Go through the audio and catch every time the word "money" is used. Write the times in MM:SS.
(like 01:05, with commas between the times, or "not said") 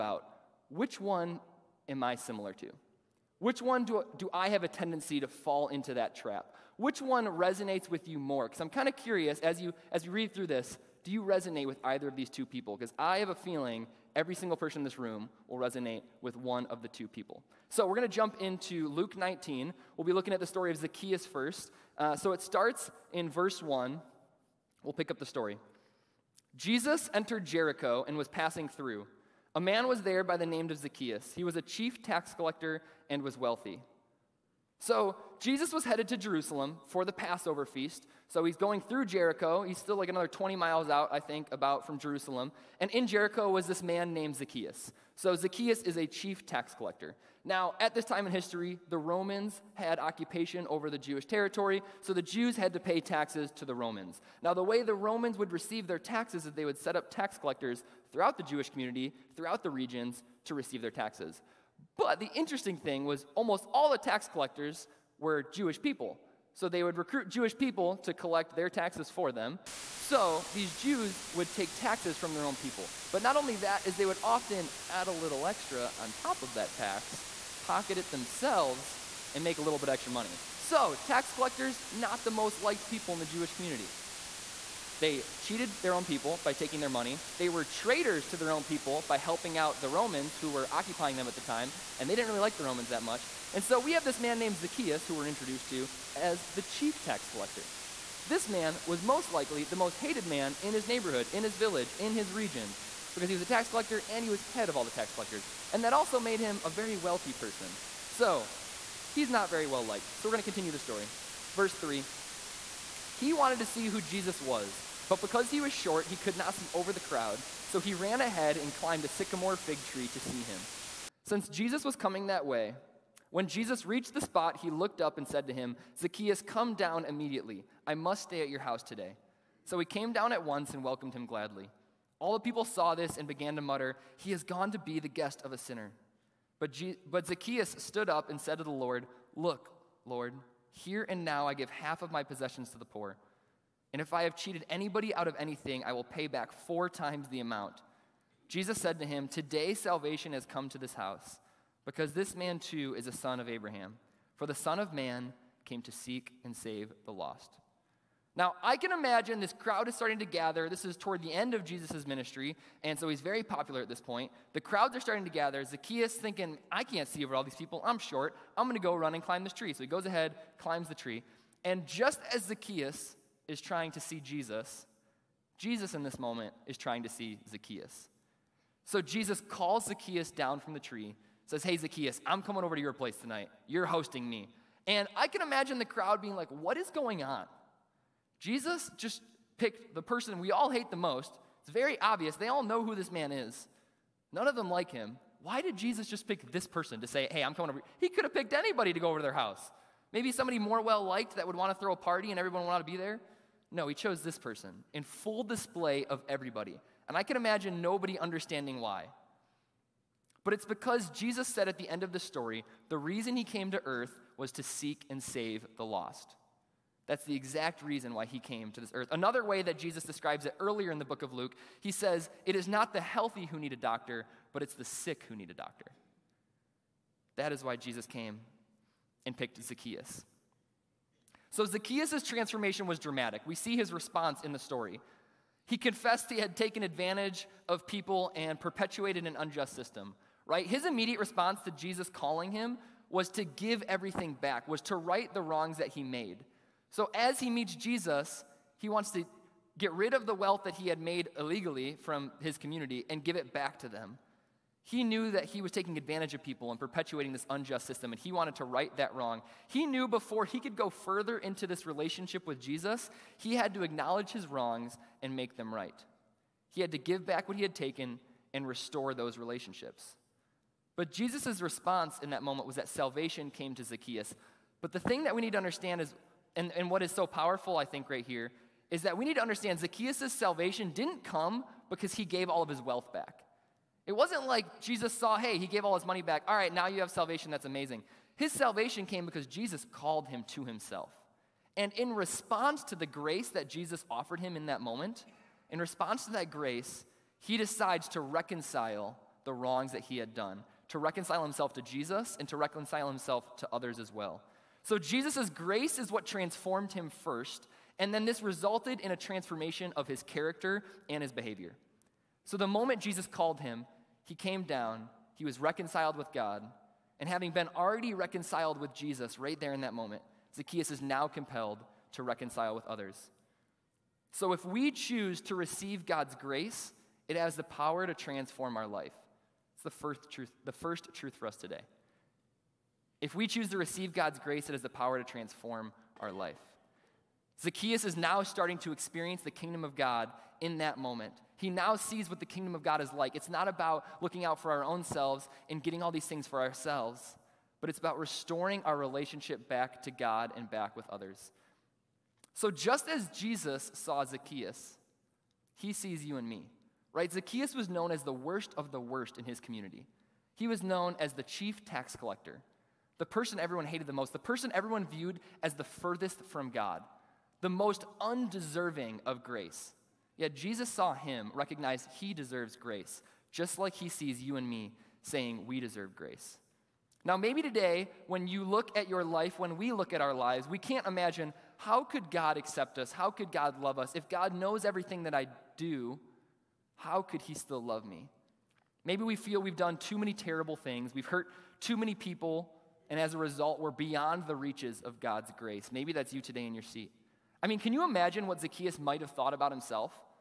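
01:20, 01:26, 04:46.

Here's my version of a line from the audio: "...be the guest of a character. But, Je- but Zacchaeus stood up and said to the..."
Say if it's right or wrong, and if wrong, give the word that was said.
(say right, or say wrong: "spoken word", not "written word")
wrong: "sinner", not "character".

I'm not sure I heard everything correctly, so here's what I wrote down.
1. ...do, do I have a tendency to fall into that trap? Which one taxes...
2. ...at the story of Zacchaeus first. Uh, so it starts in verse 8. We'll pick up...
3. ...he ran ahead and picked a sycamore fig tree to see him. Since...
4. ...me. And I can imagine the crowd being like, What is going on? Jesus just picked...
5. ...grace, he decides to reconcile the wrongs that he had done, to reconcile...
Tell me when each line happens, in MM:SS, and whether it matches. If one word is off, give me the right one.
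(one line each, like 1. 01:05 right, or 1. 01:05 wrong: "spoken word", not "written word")
1. 00:03 wrong: "resonates", not "taxes"
2. 00:20 wrong: "1", not "8"
3. 01:57 wrong: "climbed", not "picked"
4. 03:04 right
5. 04:56 right.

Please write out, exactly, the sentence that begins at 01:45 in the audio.
And that also made him a very wealthy person.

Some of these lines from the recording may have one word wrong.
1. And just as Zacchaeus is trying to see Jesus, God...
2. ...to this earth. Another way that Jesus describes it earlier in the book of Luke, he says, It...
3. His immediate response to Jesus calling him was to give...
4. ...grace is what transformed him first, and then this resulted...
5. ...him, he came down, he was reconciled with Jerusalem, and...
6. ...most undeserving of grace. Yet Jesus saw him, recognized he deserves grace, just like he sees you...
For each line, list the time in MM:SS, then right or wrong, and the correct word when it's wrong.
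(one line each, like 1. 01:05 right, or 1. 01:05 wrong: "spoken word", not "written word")
1. 02:51 wrong: "Jesus", not "God"
2. 03:38 right
3. 04:00 right
4. 05:05 right
5. 05:13 wrong: "God", not "Jerusalem"
6. 06:07 right.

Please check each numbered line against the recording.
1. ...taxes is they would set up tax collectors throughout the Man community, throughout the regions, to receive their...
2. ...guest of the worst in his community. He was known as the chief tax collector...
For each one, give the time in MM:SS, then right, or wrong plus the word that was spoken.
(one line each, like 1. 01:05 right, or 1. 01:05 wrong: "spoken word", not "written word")
1. 00:55 wrong: "Jewish", not "Man"
2. 05:58 wrong: "worst", not "guest".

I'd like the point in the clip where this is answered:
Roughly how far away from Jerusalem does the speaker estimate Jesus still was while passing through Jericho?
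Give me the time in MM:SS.
00:40.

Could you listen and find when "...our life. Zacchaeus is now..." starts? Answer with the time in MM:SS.
05:36.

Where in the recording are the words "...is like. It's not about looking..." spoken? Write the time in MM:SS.
05:43.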